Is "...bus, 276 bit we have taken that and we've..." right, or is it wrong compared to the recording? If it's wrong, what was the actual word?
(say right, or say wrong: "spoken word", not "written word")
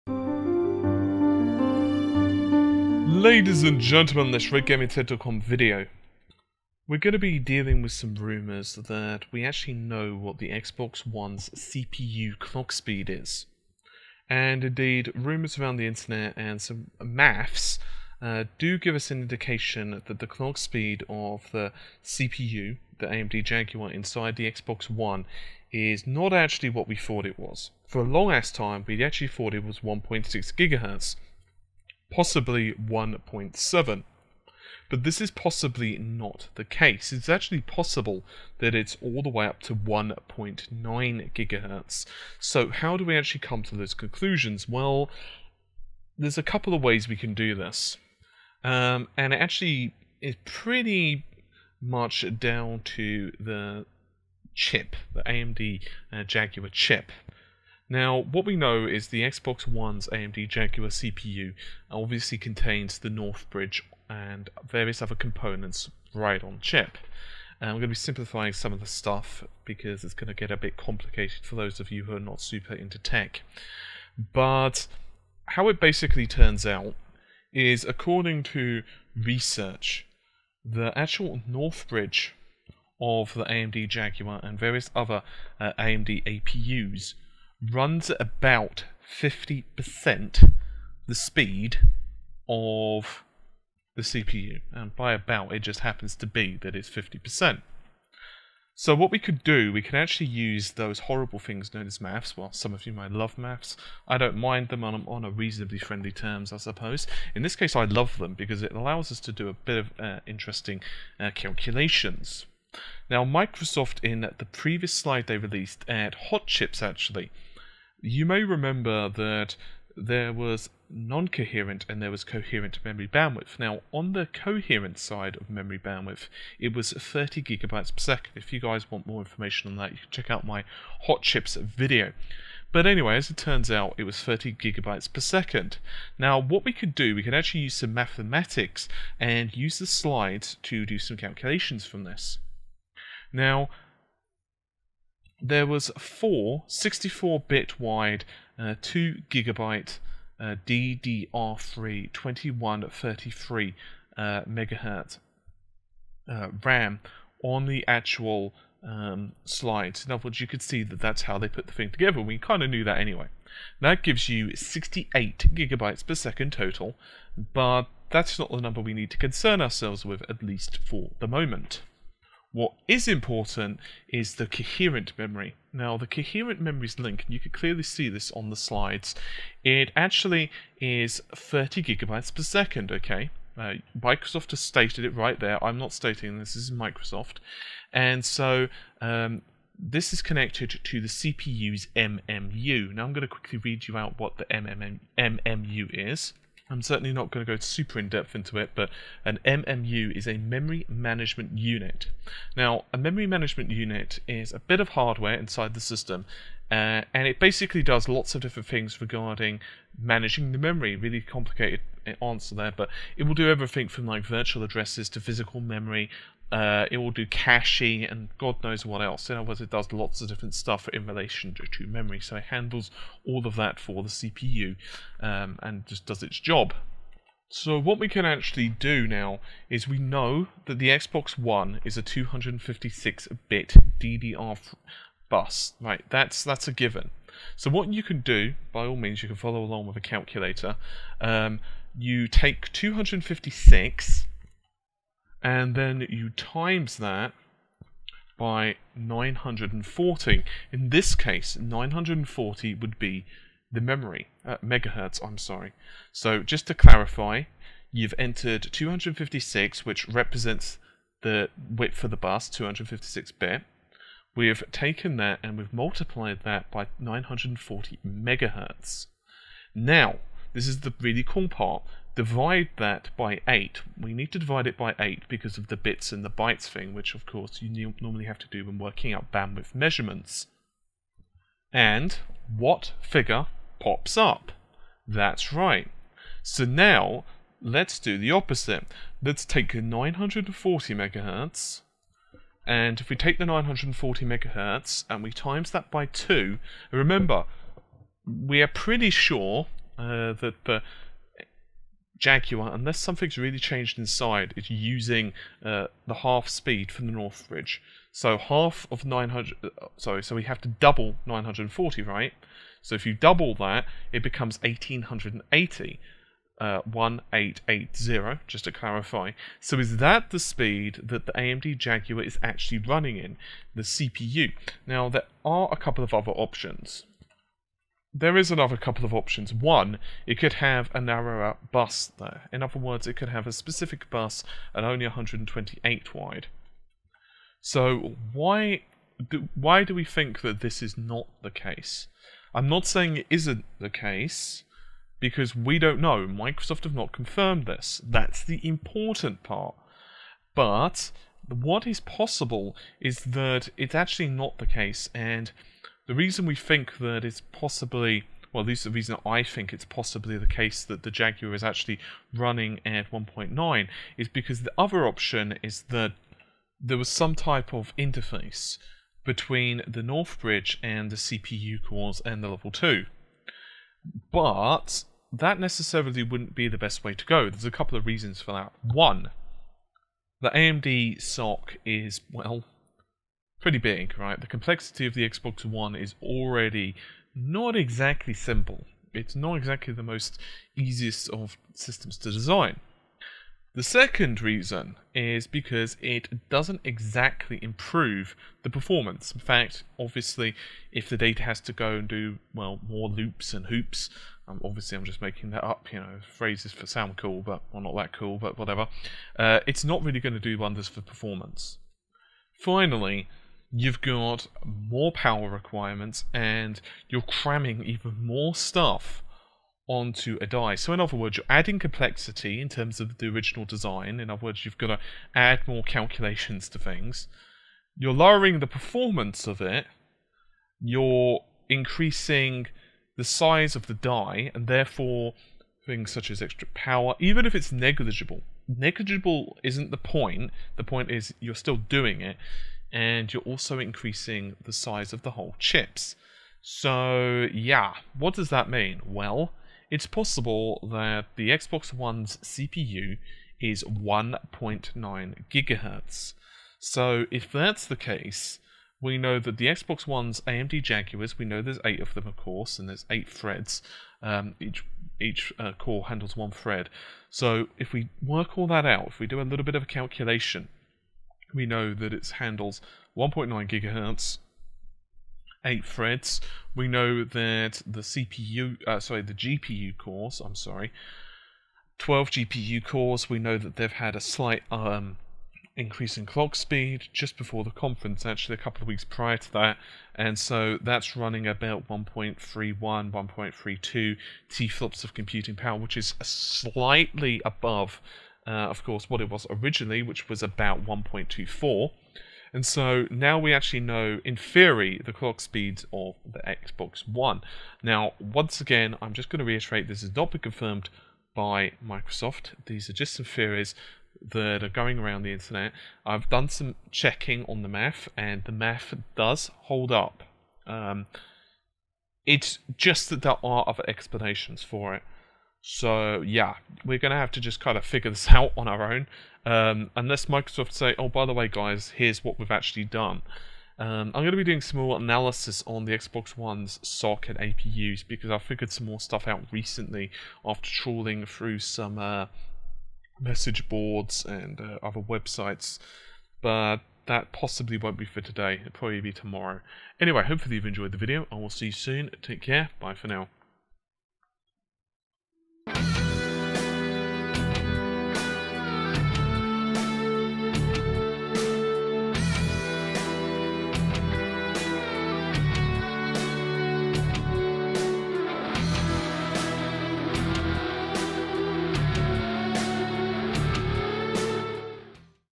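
wrong: "256", not "276".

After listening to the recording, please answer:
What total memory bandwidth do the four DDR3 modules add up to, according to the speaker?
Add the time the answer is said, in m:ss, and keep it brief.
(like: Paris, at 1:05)
68 gigabytes per second, at 2:44.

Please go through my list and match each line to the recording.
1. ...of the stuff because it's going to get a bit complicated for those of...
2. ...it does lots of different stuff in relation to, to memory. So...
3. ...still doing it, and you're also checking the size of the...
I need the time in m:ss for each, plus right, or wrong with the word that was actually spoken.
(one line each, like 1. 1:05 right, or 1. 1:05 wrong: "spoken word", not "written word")
1. 1:08 right
2. 3:39 right
3. 7:21 wrong: "increasing", not "checking".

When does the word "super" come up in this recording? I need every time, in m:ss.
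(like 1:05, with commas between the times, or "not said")
1:12, 3:17.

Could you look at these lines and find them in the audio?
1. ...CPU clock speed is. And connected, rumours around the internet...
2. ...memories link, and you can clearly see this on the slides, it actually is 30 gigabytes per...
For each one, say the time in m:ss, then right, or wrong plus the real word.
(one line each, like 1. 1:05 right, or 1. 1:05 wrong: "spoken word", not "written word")
1. 0:11 wrong: "indeed", not "connected"
2. 2:56 right.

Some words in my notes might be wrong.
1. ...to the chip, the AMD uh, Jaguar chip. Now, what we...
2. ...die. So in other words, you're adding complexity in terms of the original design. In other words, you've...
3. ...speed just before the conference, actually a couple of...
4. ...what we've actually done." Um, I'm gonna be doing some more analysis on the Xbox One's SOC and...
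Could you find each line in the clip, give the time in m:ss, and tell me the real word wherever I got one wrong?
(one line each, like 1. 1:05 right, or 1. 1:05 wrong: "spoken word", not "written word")
1. 0:52 right
2. 7:00 right
3. 8:06 right
4. 8:52 right.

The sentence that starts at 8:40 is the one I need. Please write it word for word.
Um, it's just that there are other explanations for it.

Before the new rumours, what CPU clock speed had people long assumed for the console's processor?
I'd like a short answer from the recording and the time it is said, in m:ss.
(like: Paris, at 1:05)
1.6 gigahertz, at 0:29.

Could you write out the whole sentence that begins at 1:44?
I don't mind them on, on a reasonably friendly terms, I suppose.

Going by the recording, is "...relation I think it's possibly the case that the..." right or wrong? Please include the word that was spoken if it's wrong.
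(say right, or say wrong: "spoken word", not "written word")
wrong: "reason", not "relation".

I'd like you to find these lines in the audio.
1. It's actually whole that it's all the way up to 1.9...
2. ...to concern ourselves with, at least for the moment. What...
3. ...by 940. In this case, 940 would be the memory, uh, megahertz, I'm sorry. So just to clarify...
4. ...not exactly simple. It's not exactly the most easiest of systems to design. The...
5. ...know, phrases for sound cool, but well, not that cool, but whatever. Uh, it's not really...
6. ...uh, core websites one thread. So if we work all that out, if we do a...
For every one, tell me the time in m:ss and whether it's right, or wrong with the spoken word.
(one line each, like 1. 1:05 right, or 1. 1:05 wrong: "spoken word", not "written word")
1. 0:37 wrong: "possible", not "whole"
2. 2:49 right
3. 4:08 right
4. 6:27 right
5. 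6:45 right
6. 7:45 wrong: "handles", not "websites".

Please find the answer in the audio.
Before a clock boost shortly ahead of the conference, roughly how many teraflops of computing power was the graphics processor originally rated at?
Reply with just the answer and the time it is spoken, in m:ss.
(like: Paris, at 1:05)
1.24, at 8:20.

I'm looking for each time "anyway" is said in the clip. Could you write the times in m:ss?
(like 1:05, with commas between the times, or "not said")
2:12, 2:42, 9:09.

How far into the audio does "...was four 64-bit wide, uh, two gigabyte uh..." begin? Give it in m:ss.
2:25.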